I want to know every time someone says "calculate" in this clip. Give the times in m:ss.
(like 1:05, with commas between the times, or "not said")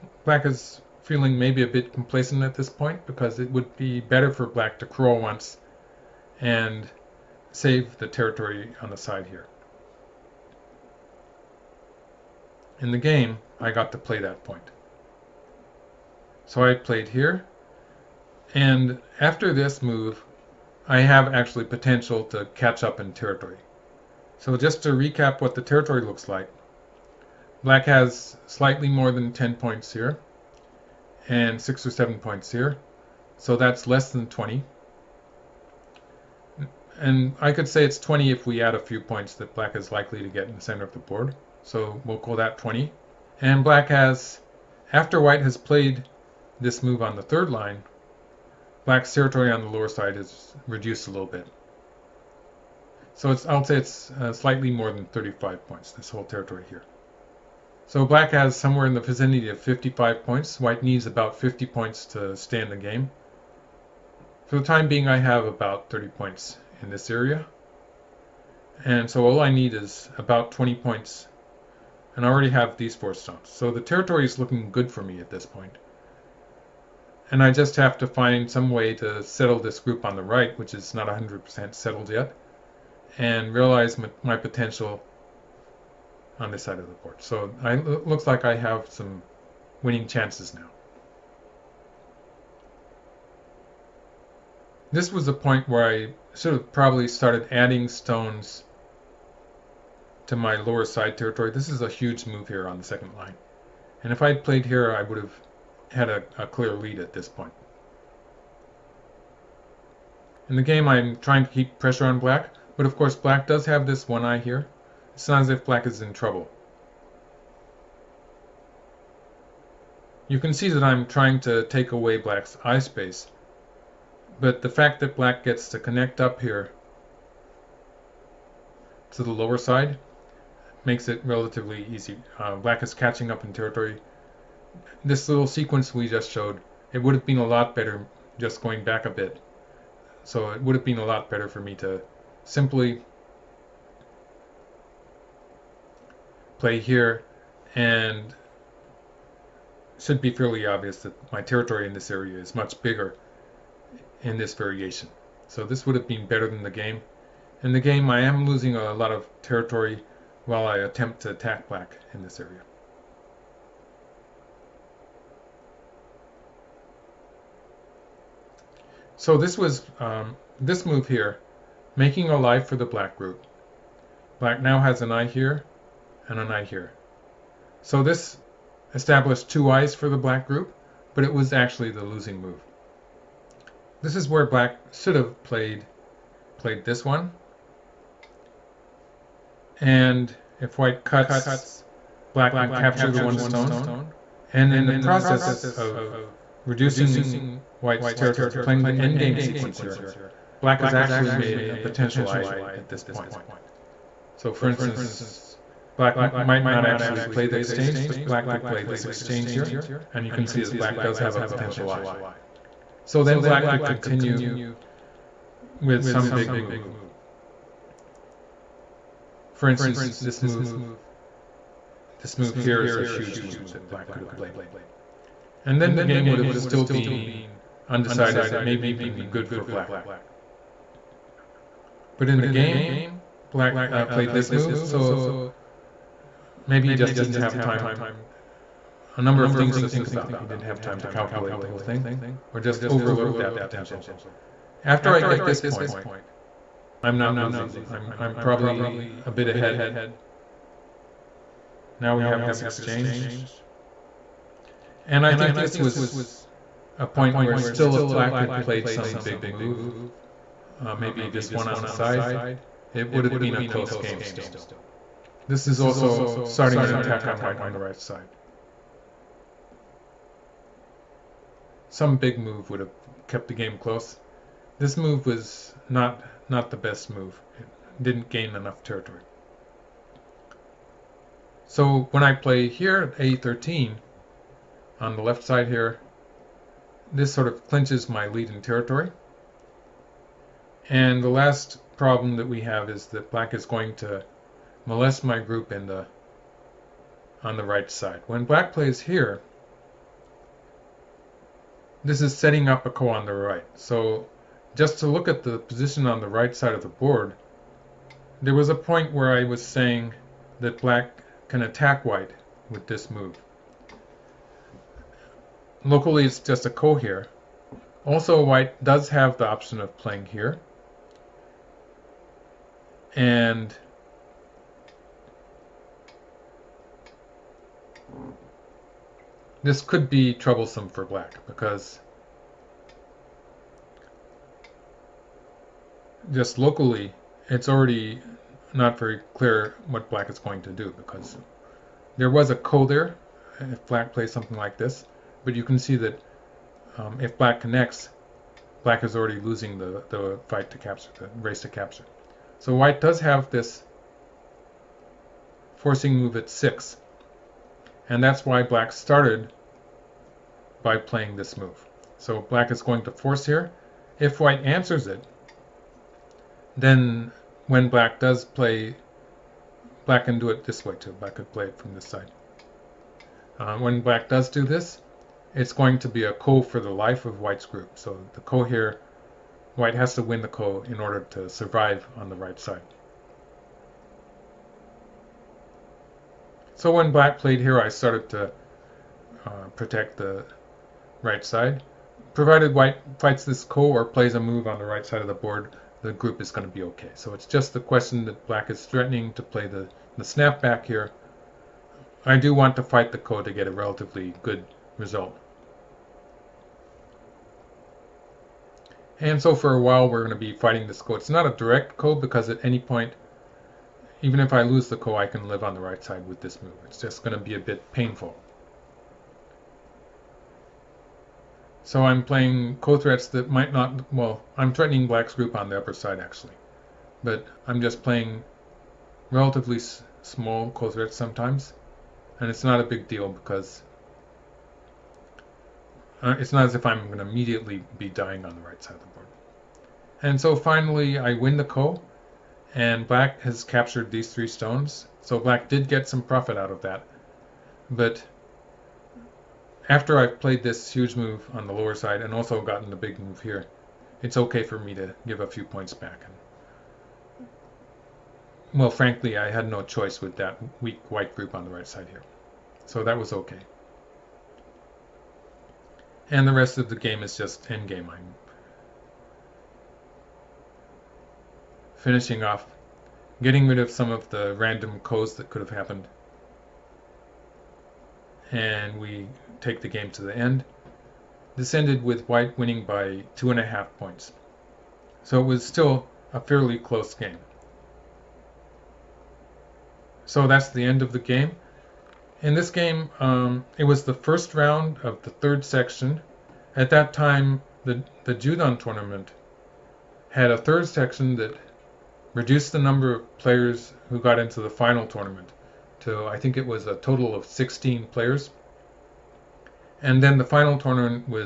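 4:01.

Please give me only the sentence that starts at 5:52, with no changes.
So white does have this forcing move at 6, and that's why black started by playing this move.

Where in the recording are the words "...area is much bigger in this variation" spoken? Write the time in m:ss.
2:32.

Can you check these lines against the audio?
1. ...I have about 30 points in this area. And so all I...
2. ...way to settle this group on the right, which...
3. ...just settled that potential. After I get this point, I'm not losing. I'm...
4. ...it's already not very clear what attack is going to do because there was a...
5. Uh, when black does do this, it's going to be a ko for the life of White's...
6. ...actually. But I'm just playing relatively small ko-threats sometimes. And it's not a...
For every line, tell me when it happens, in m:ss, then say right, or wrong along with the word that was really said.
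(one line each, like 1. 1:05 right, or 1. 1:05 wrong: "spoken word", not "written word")
1. 1:05 right
2. 1:18 right
3. 4:02 wrong: "overlooked", not "settled"
4. 5:37 wrong: "black", not "attack"
5. 6:13 right
6. 7:06 right.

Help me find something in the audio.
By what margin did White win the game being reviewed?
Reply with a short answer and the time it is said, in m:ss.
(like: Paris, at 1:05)
2.5 points, at 8:03.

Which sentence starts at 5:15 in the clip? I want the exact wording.
Locally, it's just a ko here.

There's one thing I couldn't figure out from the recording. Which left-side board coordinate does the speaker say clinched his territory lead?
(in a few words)
a13.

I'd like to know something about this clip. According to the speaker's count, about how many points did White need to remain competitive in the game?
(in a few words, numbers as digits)
50.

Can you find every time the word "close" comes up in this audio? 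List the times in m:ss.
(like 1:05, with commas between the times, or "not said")
4:23, 4:33, 8:06.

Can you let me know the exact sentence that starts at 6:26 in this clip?
So when Black played here, I started to uh, protect the right side.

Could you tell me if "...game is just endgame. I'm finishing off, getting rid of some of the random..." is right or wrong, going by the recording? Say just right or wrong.
right.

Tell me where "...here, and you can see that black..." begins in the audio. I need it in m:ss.
3:29.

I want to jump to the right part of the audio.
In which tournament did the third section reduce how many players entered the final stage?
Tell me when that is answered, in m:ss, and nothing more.
8:18.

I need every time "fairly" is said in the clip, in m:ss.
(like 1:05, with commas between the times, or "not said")
2:30, 8:06.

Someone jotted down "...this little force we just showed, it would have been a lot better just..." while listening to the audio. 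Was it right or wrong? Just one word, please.
wrong.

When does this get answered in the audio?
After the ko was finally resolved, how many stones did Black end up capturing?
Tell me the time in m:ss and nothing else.
7:24.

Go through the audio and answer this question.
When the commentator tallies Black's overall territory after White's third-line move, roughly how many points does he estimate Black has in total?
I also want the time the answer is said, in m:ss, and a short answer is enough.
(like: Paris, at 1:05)
55, at 0:59.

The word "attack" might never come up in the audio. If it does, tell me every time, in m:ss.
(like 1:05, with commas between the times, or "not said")
2:41, 4:26, 5:11.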